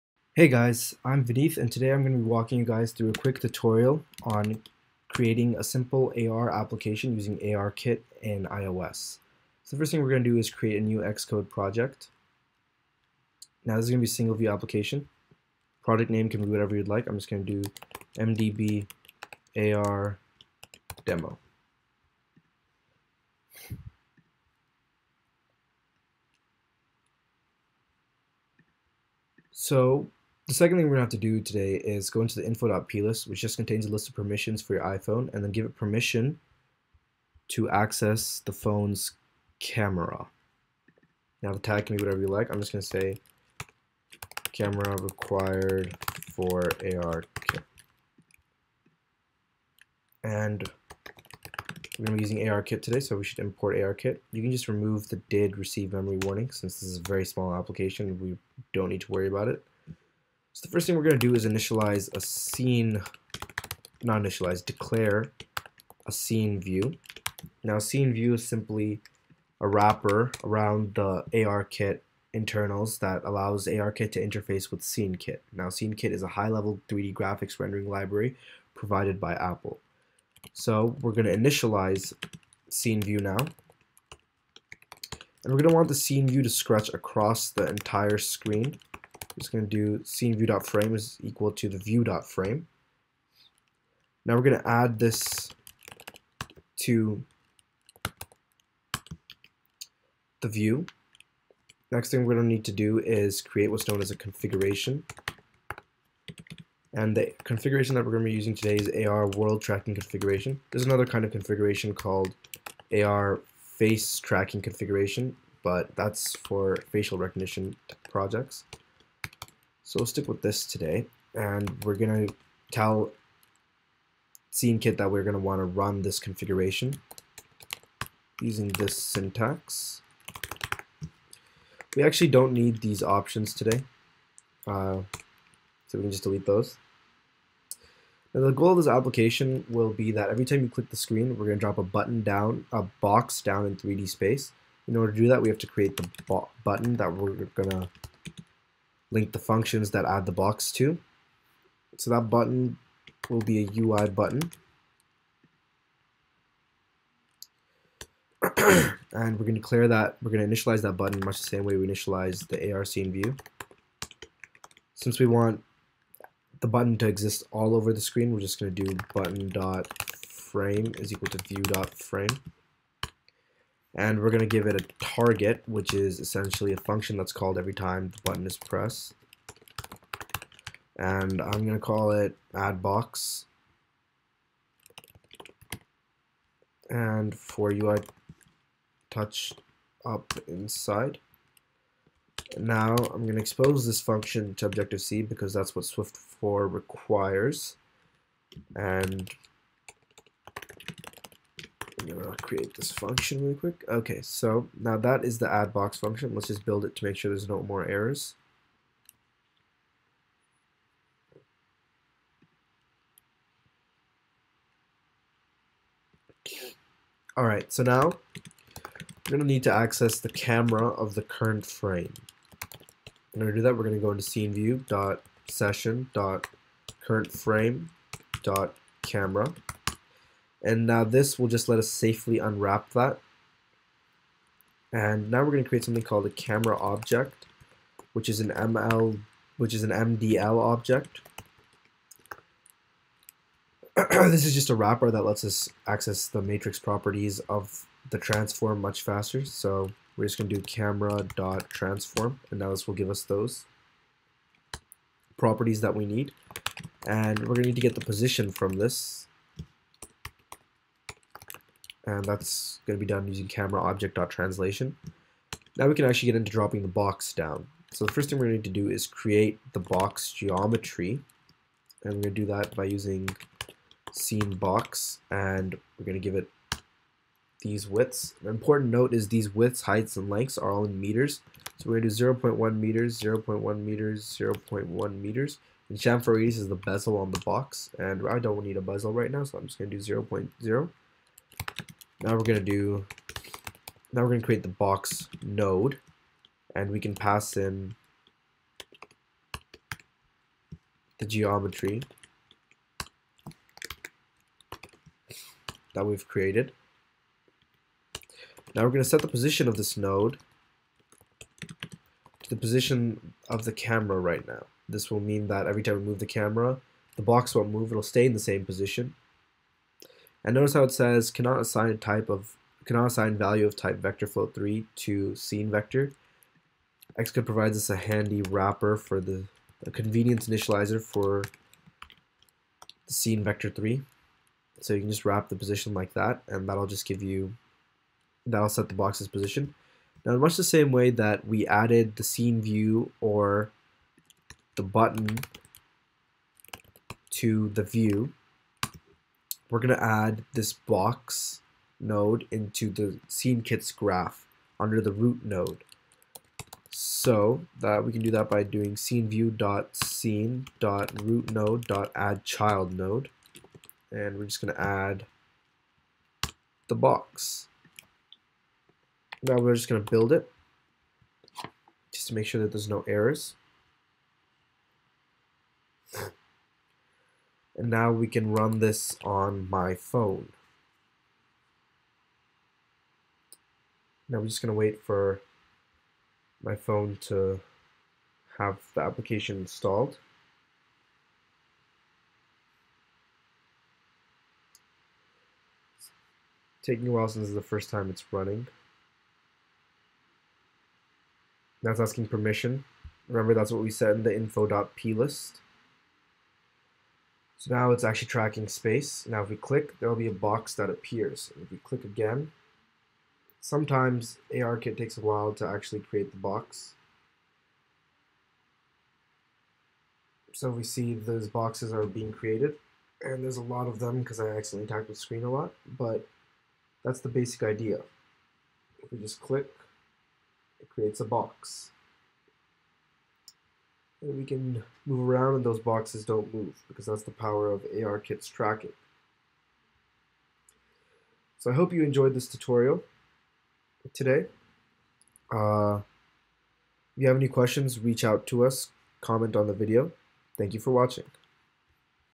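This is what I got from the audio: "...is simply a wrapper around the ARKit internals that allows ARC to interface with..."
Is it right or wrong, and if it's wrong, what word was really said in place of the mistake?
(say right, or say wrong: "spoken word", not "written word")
wrong: "ARKit", not "ARC".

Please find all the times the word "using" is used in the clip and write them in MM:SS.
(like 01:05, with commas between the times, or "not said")
00:07, 00:52, 01:48, 02:08, 04:23, 04:32.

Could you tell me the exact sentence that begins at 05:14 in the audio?
This will mean that every time we move the camera, the box won't move, it'll stay in the same position.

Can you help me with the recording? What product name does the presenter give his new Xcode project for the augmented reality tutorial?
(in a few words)
MDB AR demo.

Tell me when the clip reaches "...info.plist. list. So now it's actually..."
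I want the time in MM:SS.
06:44.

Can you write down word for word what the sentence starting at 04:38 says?
An important note is these widths, heights, and lengths are all in meters.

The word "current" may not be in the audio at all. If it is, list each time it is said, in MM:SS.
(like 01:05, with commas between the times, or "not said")
03:41, 03:47.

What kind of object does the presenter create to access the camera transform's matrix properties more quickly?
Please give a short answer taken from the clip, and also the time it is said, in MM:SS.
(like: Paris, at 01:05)
MDL object, at 03:59.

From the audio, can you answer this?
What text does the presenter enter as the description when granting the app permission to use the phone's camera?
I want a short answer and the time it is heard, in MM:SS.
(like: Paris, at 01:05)
camera required for AR kit, at 00:44.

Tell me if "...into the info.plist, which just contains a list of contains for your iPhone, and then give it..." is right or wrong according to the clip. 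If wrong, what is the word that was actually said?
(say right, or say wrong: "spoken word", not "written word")
wrong: "permissions", not "contains".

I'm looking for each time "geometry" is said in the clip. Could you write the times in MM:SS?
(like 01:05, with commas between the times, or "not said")
04:30, 05:01.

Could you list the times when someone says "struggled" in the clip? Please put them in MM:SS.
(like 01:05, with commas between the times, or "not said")
not said.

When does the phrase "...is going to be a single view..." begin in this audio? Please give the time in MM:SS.
00:13.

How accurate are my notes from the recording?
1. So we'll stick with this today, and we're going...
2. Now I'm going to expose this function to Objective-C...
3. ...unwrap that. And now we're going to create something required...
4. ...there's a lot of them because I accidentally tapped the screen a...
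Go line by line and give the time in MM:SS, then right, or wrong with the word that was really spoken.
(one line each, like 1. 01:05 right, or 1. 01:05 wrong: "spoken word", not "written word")
1. 01:59 right
2. 03:12 right
3. 03:52 wrong: "called", not "required"
4. 07:03 right.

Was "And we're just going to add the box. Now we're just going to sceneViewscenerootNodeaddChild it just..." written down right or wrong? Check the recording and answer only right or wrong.
wrong.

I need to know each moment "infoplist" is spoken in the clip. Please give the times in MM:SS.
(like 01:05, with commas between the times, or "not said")
00:32, 06:44.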